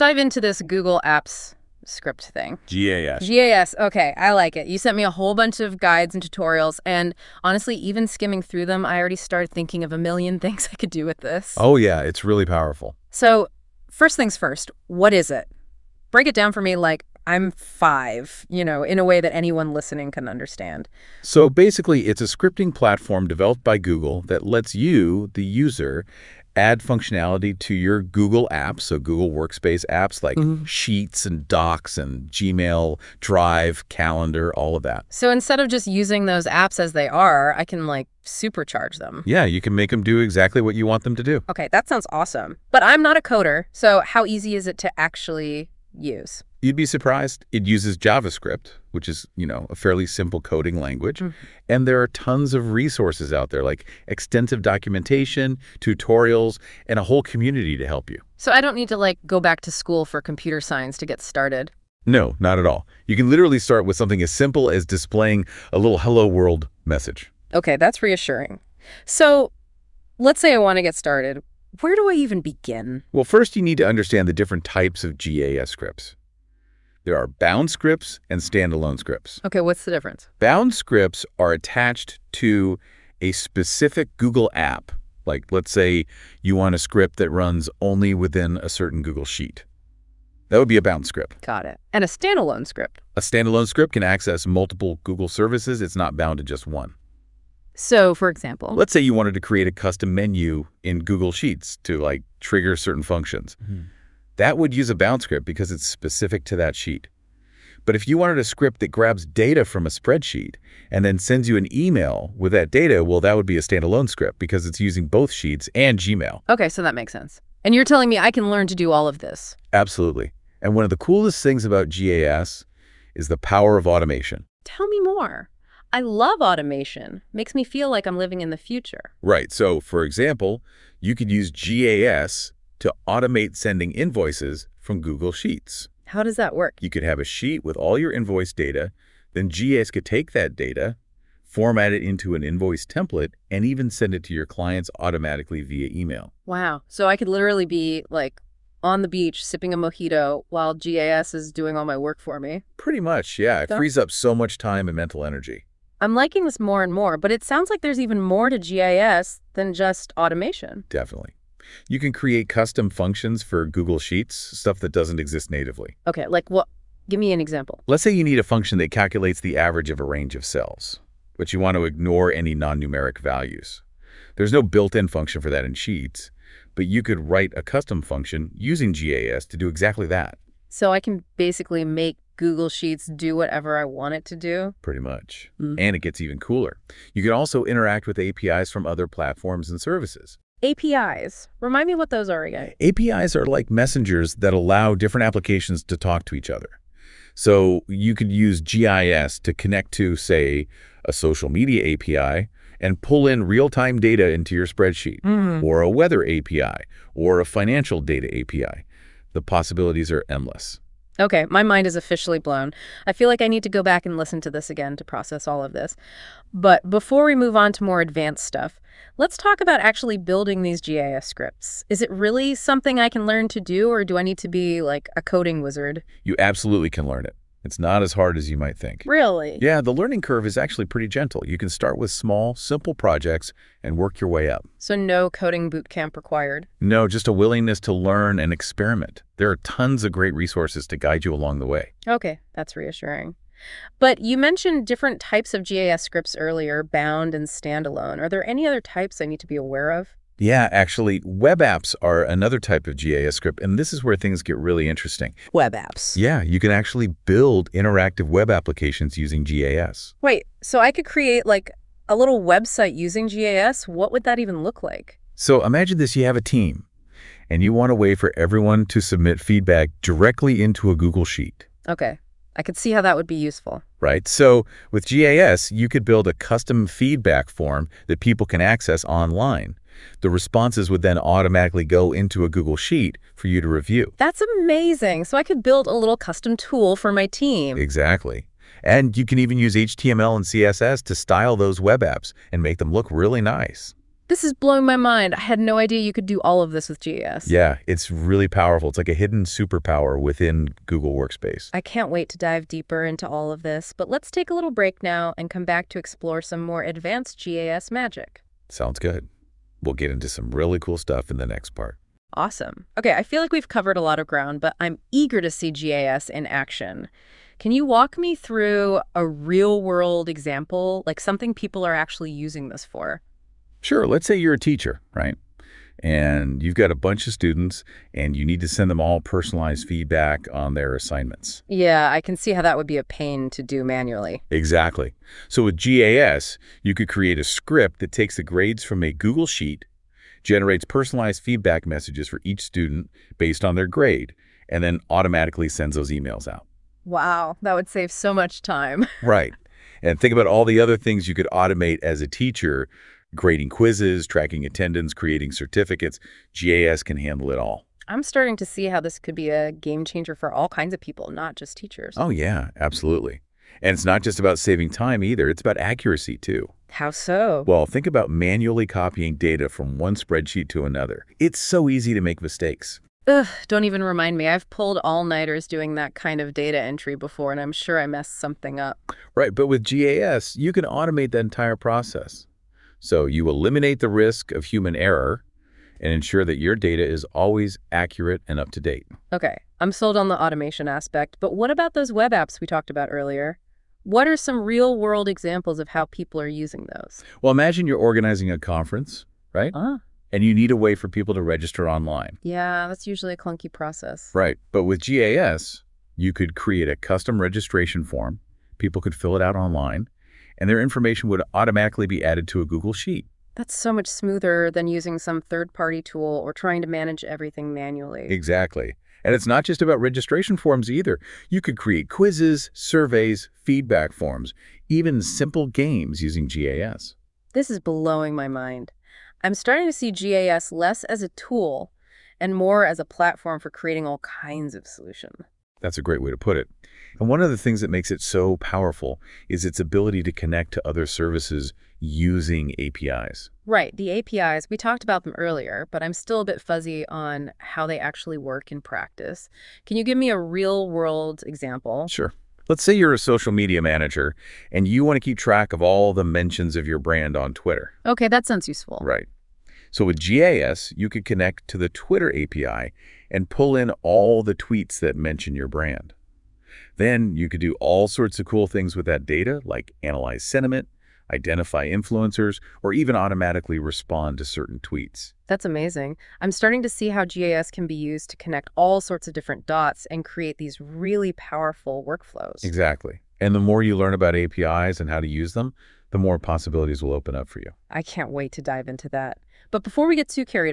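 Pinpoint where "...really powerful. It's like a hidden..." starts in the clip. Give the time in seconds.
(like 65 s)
298 s.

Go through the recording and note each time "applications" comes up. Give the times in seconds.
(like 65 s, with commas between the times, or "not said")
195 s, 258 s.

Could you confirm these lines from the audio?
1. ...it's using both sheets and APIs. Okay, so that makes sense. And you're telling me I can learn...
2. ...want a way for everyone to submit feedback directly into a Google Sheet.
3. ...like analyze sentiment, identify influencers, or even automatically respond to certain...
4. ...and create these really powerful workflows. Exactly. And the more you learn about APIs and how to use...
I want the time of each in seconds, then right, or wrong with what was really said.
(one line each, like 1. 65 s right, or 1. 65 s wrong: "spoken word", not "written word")
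1. 114 s wrong: "Gmail", not "APIs"
2. 267 s right
3. 469 s right
4. 480 s right.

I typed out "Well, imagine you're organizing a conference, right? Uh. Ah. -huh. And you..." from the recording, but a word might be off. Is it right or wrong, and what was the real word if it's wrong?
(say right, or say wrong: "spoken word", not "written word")
right.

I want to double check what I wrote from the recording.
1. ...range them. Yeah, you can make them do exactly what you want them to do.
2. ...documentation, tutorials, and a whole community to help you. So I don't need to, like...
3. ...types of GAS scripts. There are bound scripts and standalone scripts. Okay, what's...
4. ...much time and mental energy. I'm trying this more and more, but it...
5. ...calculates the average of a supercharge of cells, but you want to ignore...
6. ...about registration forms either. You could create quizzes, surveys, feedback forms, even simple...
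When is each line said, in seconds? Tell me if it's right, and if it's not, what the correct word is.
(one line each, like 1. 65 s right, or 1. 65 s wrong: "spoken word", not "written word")
1. 38 s wrong: "supercharge", not "range"
2. 54 s right
3. 74 s right
4. 154 s wrong: "liking", not "trying"
5. 168 s wrong: "range", not "supercharge"
6. 419 s right.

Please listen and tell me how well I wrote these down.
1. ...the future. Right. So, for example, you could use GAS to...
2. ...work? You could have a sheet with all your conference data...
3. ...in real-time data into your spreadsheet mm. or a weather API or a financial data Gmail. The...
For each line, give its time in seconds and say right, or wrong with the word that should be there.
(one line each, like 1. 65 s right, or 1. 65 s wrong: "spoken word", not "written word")
1. 128 s right
2. 136 s wrong: "invoice", not "conference"
3. 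203 s wrong: "API", not "Gmail".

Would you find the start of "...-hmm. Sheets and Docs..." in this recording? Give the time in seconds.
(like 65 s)
30 s.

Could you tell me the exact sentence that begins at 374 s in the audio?
I've pulled all-nighters doing that kind of data entry before, and I'm sure I messed something up.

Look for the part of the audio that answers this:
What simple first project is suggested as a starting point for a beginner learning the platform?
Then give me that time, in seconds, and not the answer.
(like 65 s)
65 s.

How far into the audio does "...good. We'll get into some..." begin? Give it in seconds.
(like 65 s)
308 s.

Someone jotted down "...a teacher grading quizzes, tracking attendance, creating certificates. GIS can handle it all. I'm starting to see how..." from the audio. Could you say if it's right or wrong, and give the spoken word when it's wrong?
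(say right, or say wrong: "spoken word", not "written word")
right.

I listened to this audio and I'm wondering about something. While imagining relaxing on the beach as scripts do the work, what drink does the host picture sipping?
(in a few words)
mojito.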